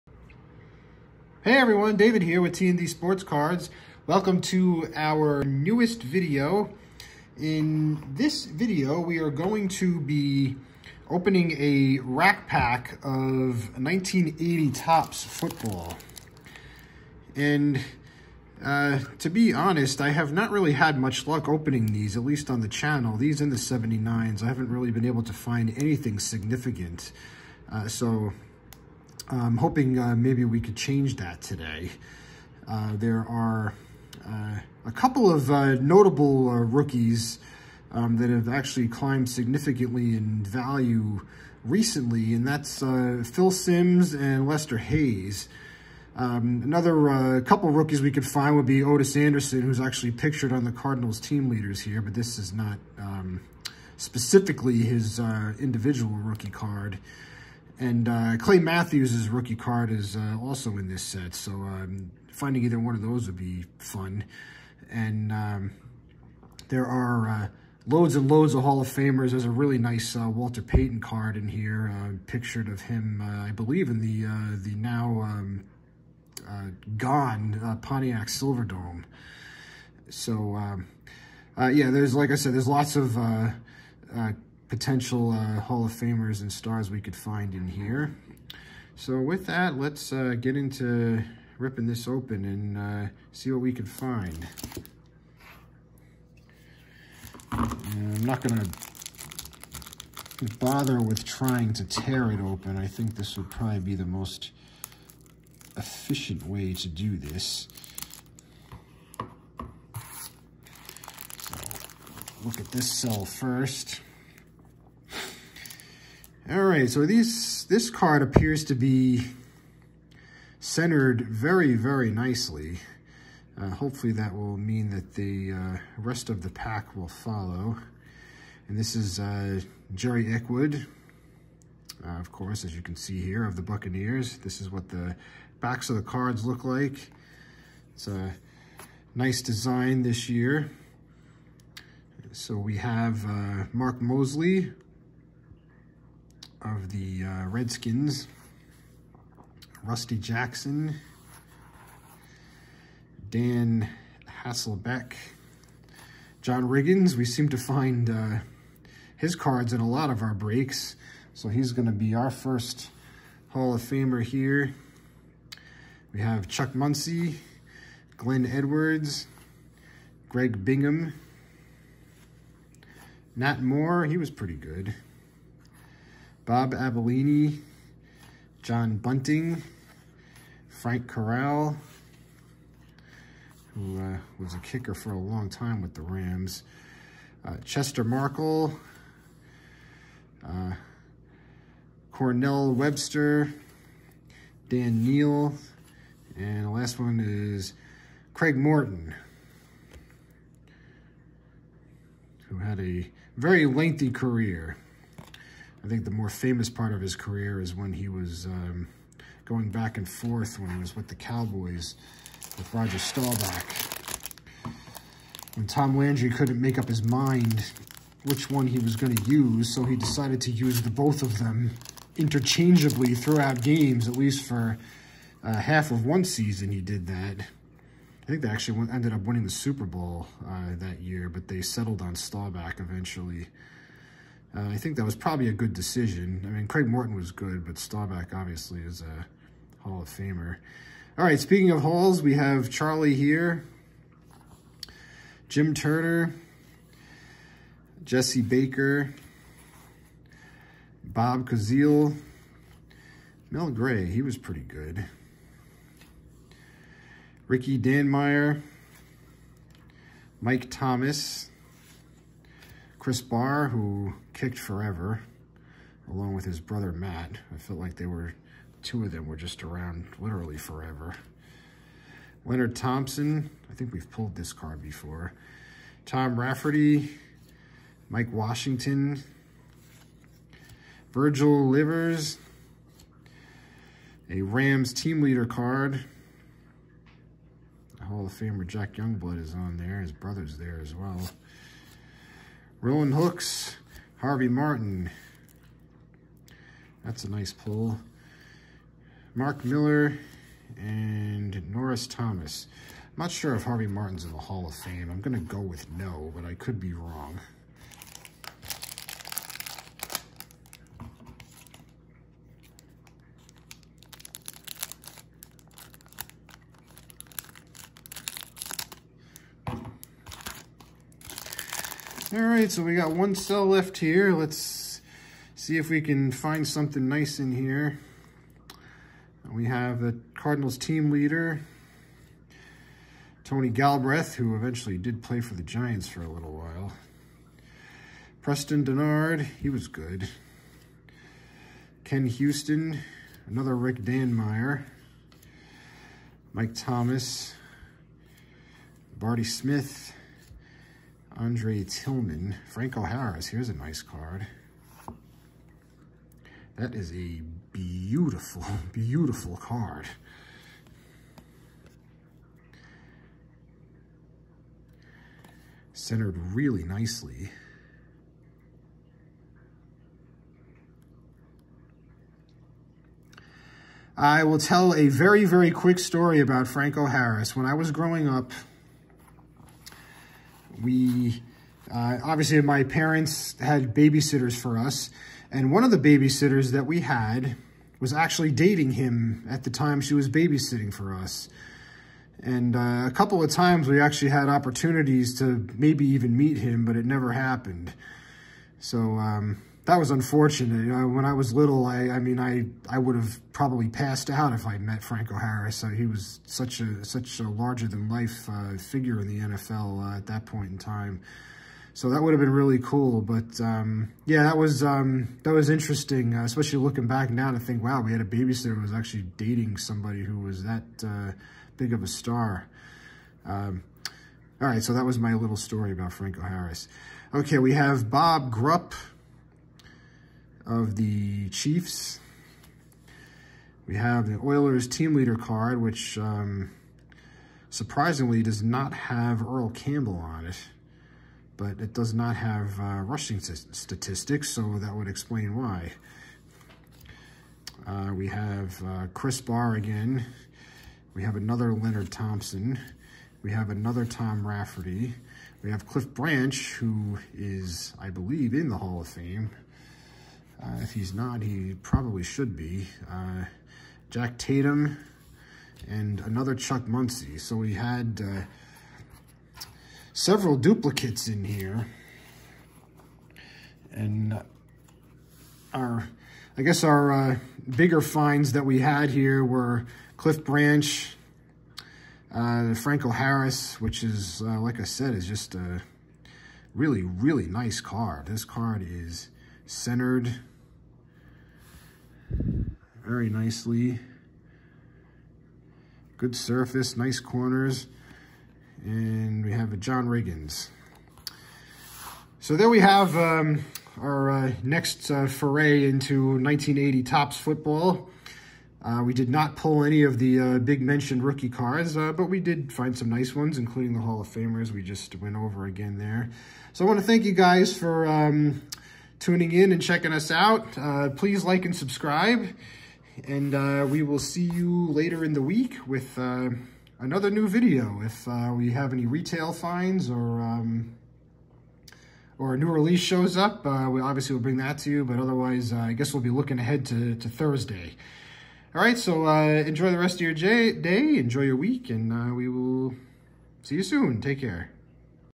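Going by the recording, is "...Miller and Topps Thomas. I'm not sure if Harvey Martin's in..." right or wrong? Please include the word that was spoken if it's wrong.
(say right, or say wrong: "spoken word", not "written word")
wrong: "Norris", not "Topps".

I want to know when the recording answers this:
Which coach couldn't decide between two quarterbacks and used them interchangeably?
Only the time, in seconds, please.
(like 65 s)
215 s.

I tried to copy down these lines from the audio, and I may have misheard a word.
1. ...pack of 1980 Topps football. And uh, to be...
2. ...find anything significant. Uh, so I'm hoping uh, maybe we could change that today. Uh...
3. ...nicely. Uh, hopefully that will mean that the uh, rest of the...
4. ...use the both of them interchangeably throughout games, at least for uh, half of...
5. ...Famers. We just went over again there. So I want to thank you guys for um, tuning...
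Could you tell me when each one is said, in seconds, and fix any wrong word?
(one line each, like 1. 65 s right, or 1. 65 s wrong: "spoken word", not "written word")
1. 12 s right
2. 25 s right
3. 122 s right
4. 220 s right
5. 514 s right.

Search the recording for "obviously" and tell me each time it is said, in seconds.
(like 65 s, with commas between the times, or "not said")
238 s, 382 s, 534 s.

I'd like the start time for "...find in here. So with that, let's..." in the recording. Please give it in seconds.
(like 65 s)
87 s.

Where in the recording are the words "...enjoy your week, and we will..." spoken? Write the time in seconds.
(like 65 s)
540 s.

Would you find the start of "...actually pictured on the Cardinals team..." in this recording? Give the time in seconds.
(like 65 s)
49 s.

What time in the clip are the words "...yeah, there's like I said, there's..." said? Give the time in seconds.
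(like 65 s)
81 s.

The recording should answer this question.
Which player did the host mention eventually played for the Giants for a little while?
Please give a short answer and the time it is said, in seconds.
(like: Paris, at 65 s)
Tony Galbreath, at 333 s.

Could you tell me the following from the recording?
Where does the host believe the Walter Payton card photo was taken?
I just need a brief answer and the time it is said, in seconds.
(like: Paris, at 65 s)
Pontiac Silverdome, at 77 s.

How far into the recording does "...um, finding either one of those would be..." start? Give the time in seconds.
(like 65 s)
61 s.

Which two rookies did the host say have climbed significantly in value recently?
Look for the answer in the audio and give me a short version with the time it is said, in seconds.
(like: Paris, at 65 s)
Phil Simms and Lester Hayes, at 43 s.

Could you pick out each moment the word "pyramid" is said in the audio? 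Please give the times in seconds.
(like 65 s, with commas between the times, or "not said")
not said.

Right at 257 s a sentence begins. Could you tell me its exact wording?
Ricky Danmeier, Mike Thomas, Chris Bahr, who kicked forever, along with his brother Matt.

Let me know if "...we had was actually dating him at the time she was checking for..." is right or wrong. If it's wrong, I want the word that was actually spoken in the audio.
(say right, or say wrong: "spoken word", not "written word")
wrong: "babysitting", not "checking".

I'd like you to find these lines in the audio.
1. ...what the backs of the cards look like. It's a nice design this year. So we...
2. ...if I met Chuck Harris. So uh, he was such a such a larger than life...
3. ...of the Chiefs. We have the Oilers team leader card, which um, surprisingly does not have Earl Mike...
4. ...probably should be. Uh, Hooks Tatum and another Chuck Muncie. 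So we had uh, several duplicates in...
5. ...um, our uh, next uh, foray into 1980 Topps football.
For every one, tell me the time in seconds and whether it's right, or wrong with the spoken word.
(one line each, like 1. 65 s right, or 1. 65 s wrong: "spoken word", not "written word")
1. 134 s right
2. 404 s wrong: "Franco", not "Chuck"
3. 430 s wrong: "Campbell", not "Mike"
4. 461 s wrong: "Jack", not "Hooks"
5. 503 s right.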